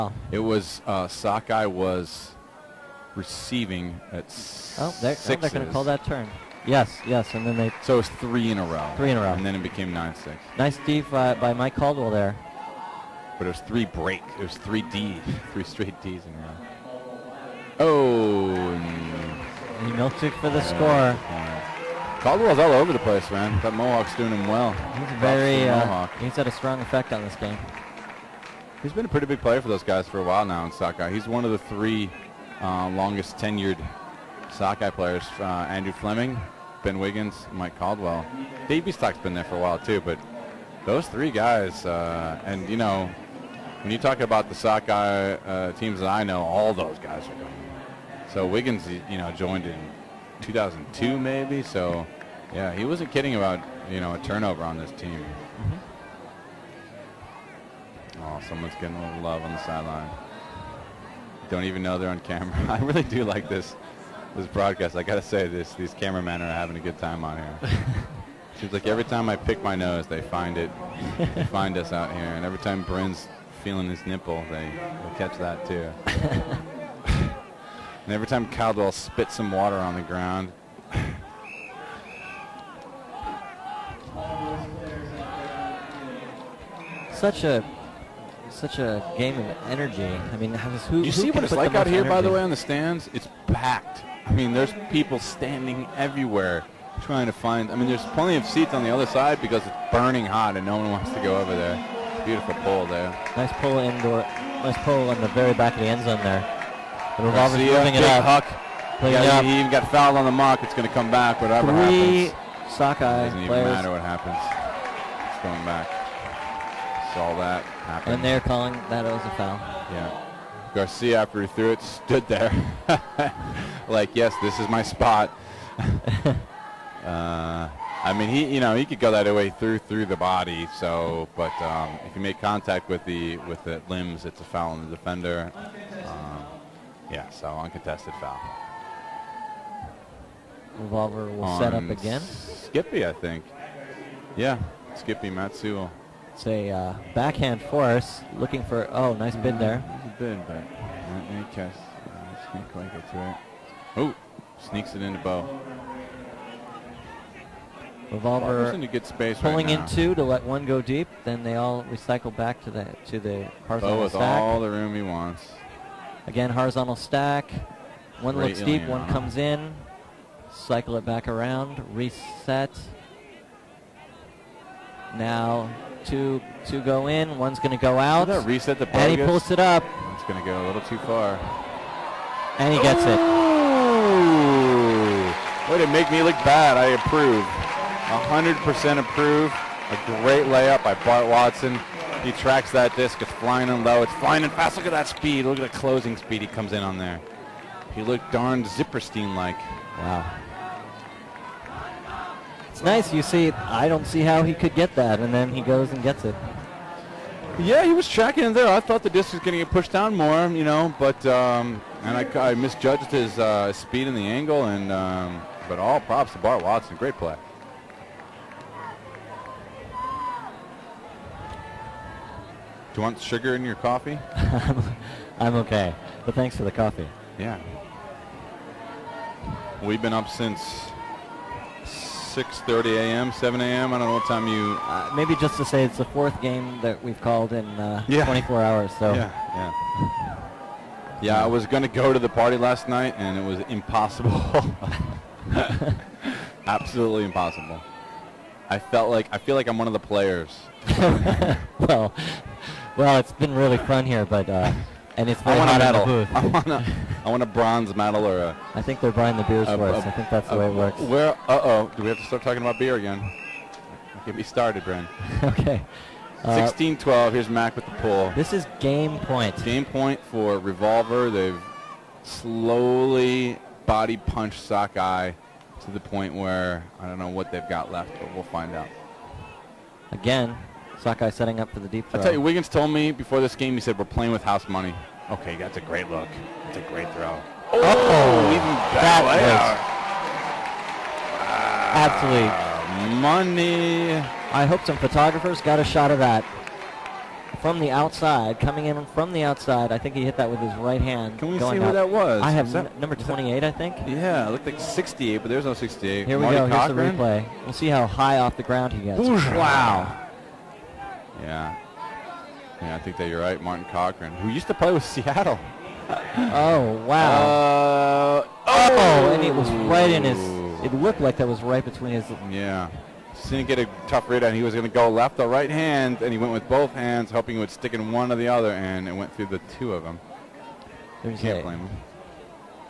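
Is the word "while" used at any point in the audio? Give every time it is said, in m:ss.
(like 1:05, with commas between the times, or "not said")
0:30, 0:39.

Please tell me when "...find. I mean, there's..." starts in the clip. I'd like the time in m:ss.
1:37.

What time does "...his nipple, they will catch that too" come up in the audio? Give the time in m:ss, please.
1:13.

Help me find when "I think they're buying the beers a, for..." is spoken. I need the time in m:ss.
4:18.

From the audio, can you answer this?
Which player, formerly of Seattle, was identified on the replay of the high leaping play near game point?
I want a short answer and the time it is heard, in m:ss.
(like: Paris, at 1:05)
Martin Cochran, at 5:13.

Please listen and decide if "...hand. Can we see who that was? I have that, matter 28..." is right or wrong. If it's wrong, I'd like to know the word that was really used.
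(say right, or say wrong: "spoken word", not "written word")
wrong: "number", not "matter".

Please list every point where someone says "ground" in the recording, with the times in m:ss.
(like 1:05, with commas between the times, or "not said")
1:20, 5:08.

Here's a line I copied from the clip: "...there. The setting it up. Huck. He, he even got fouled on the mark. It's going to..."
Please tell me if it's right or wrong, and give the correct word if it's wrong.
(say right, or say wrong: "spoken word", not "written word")
wrong: "moving", not "setting".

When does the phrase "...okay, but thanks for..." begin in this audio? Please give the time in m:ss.
3:45.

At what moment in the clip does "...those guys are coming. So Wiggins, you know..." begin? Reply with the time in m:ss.
0:46.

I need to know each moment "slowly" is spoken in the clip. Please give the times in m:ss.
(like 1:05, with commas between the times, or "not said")
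4:32.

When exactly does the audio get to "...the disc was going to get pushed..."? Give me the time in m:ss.
3:29.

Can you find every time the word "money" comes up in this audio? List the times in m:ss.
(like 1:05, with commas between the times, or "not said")
4:44, 4:53.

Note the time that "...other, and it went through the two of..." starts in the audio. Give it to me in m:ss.
5:28.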